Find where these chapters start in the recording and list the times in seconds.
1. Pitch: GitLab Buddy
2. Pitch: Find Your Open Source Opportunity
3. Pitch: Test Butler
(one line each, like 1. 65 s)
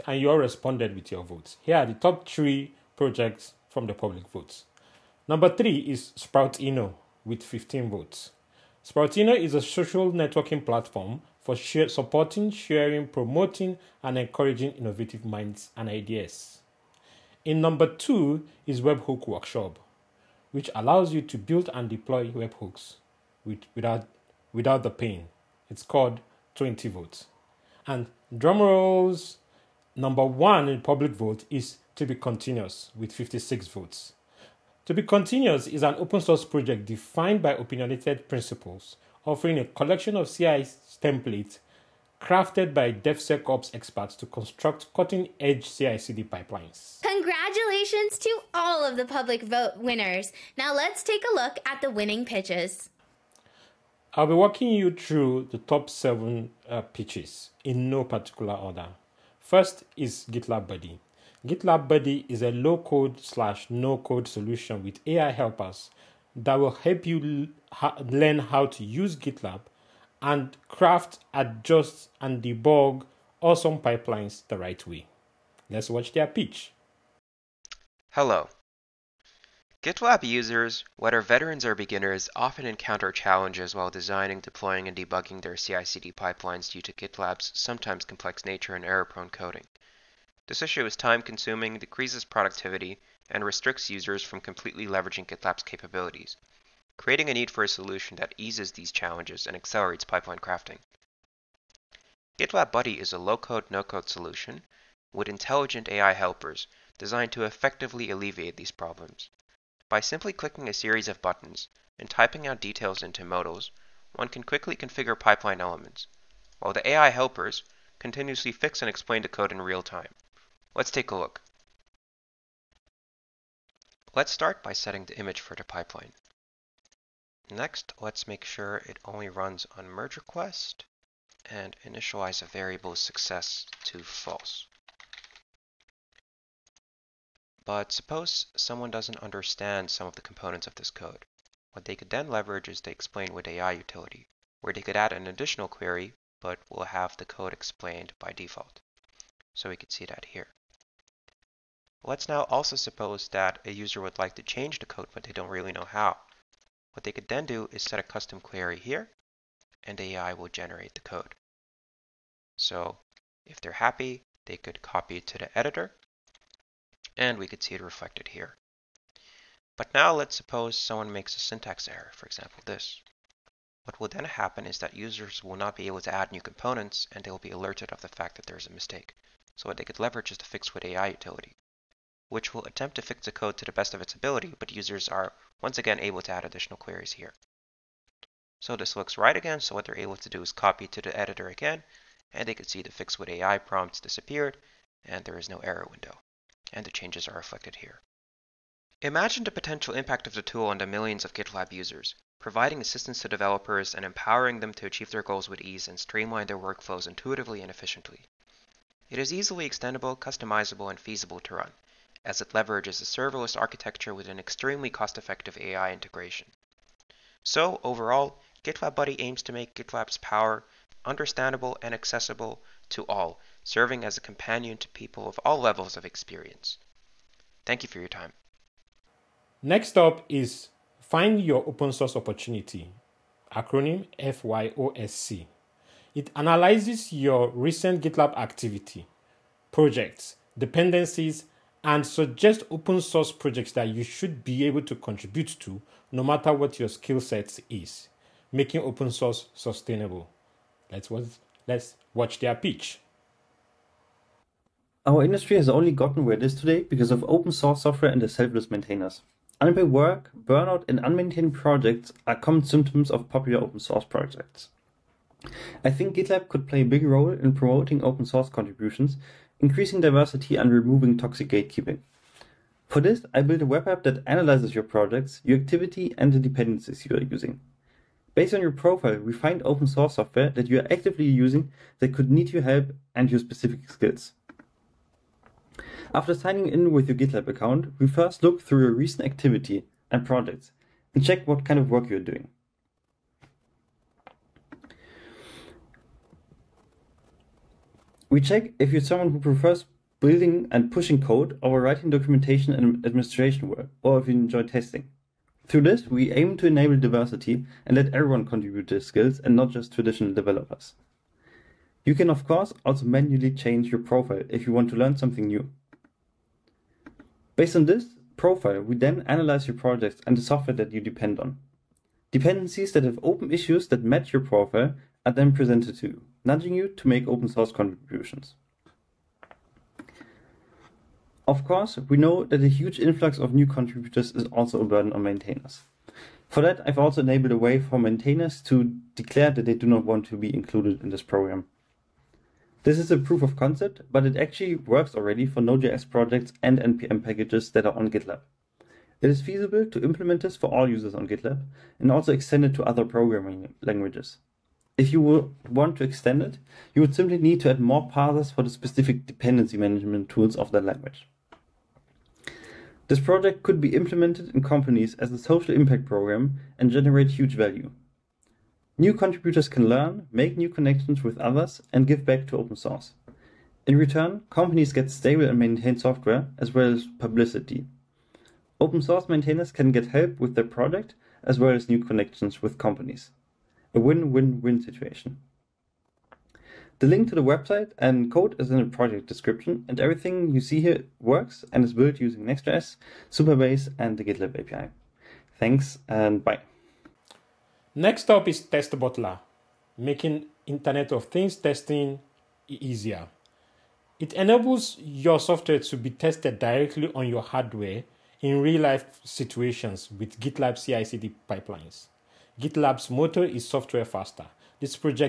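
1. 58 s
2. 228 s
3. 397 s.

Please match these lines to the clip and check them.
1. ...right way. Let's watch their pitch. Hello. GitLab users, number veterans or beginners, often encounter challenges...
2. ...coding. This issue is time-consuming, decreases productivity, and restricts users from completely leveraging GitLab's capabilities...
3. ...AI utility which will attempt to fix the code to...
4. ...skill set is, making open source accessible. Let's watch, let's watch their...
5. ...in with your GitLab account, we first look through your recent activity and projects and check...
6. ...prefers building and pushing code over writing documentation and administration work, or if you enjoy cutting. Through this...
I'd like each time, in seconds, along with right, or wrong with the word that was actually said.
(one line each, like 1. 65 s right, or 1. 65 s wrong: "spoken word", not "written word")
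1. 74 s wrong: "whether", not "number"
2. 89 s right
3. 180 s right
4. 246 s wrong: "sustainable", not "accessible"
5. 286 s right
6. 299 s wrong: "testing", not "cutting".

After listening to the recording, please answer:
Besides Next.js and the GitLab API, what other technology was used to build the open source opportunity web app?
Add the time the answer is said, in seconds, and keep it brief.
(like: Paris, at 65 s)
Supabase, at 393 s.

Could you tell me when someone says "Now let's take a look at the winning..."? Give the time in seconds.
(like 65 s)
50 s.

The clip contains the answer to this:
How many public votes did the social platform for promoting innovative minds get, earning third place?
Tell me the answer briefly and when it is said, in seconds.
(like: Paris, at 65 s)
15, at 7 s.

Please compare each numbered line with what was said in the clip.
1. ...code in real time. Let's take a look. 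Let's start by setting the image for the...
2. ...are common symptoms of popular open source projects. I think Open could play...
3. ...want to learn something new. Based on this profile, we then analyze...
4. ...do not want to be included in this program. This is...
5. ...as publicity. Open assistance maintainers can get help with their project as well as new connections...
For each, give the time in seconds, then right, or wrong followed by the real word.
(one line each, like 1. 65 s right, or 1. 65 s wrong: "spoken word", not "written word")
1. 119 s right
2. 262 s wrong: "GitLab", not "Open"
3. 314 s right
4. 339 s right
5. 376 s wrong: "source", not "assistance".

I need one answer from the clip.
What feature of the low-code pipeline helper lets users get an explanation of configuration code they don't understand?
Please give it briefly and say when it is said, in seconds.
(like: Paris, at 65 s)
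Explain with AI, at 142 s.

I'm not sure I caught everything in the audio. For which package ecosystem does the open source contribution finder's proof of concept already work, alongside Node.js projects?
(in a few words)
NPM.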